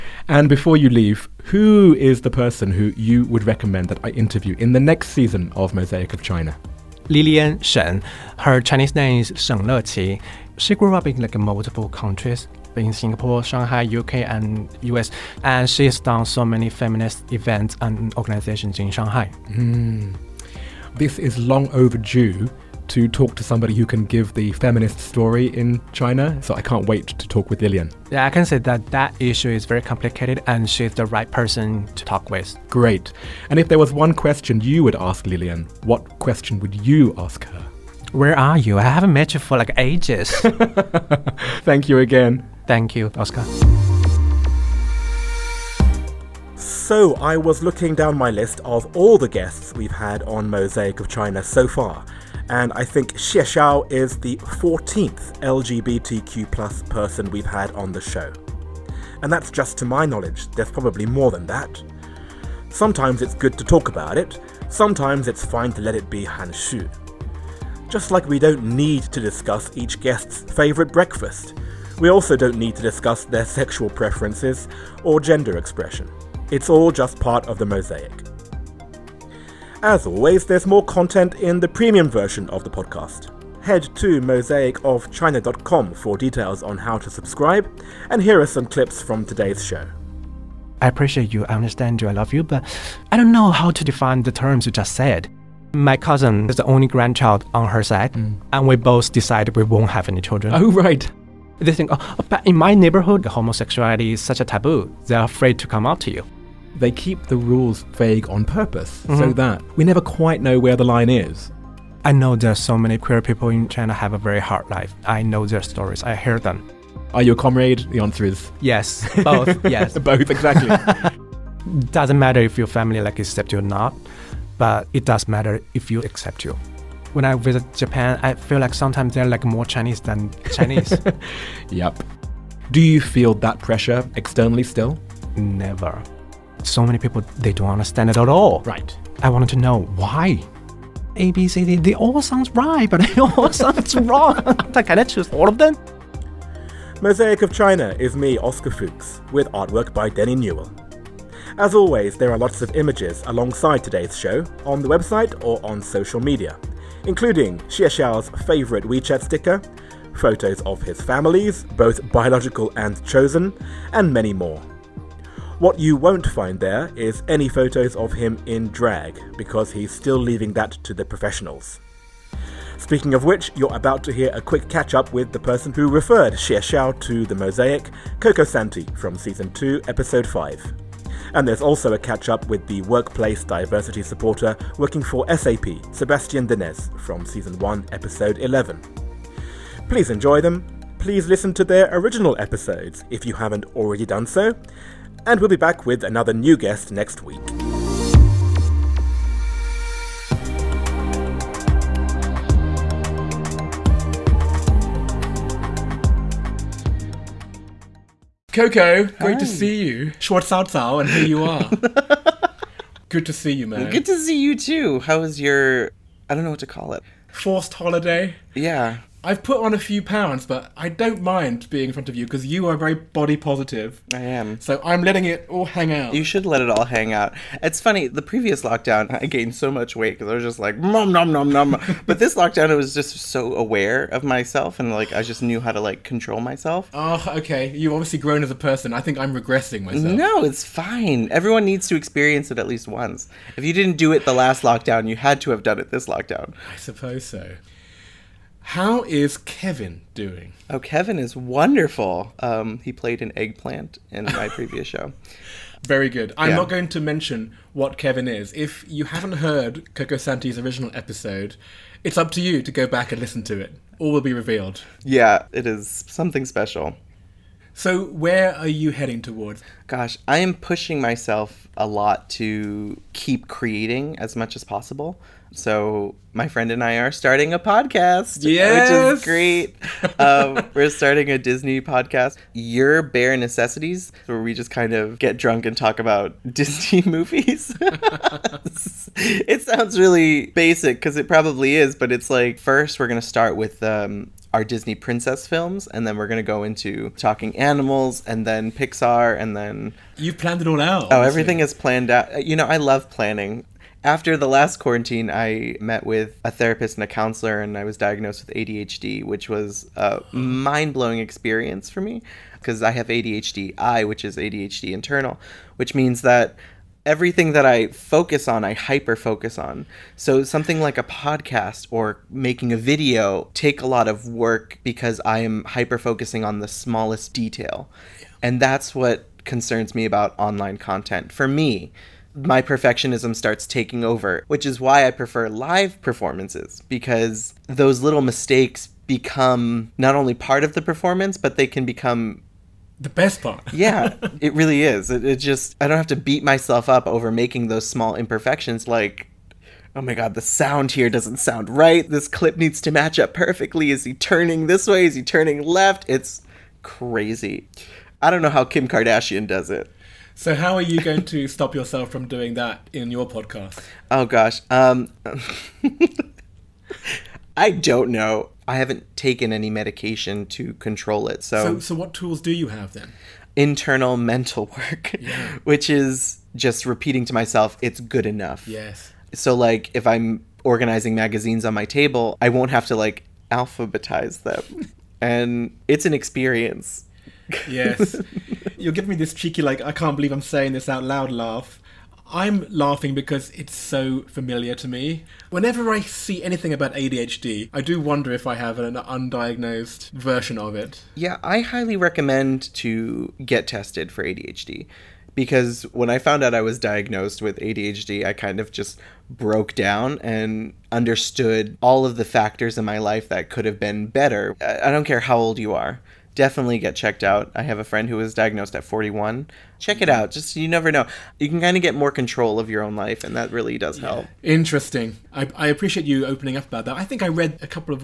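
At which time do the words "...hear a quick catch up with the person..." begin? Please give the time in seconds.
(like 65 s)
174 s.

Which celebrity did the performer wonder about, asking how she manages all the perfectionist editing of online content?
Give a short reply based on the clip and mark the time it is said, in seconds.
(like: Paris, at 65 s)
Kim Kardashian, at 358 s.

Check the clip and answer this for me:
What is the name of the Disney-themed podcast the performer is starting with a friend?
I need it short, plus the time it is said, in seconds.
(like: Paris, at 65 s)
Your Bare Necessities, at 282 s.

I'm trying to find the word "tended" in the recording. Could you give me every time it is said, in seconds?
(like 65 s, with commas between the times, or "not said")
not said.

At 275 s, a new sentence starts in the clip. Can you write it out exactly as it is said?
So, my friend and I are starting a podcast.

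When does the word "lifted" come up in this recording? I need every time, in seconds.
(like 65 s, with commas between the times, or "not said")
not said.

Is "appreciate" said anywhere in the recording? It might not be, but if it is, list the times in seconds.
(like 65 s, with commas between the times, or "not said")
90 s, 425 s.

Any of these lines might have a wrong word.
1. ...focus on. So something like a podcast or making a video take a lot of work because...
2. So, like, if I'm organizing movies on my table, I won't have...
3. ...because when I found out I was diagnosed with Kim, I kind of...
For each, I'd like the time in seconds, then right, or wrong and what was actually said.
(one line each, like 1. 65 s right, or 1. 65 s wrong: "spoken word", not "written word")
1. 319 s right
2. 379 s wrong: "magazines", not "movies"
3. 405 s wrong: "ADHD", not "Kim".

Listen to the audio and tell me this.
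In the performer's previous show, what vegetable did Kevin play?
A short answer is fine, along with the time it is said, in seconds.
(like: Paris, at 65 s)
eggplant, at 253 s.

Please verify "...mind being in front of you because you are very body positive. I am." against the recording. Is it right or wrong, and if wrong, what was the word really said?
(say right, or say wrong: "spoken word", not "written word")
right.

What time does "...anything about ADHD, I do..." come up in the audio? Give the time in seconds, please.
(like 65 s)
396 s.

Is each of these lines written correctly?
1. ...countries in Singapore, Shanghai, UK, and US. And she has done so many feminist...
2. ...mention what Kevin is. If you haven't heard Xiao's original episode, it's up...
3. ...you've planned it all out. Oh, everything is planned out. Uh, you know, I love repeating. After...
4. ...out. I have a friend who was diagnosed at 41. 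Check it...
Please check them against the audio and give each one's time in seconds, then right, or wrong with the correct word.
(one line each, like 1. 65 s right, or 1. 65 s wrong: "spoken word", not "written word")
1. 11 s right
2. 256 s wrong: "Cocosanti", not "Xiao"
3. 300 s wrong: "planning", not "repeating"
4. 417 s right.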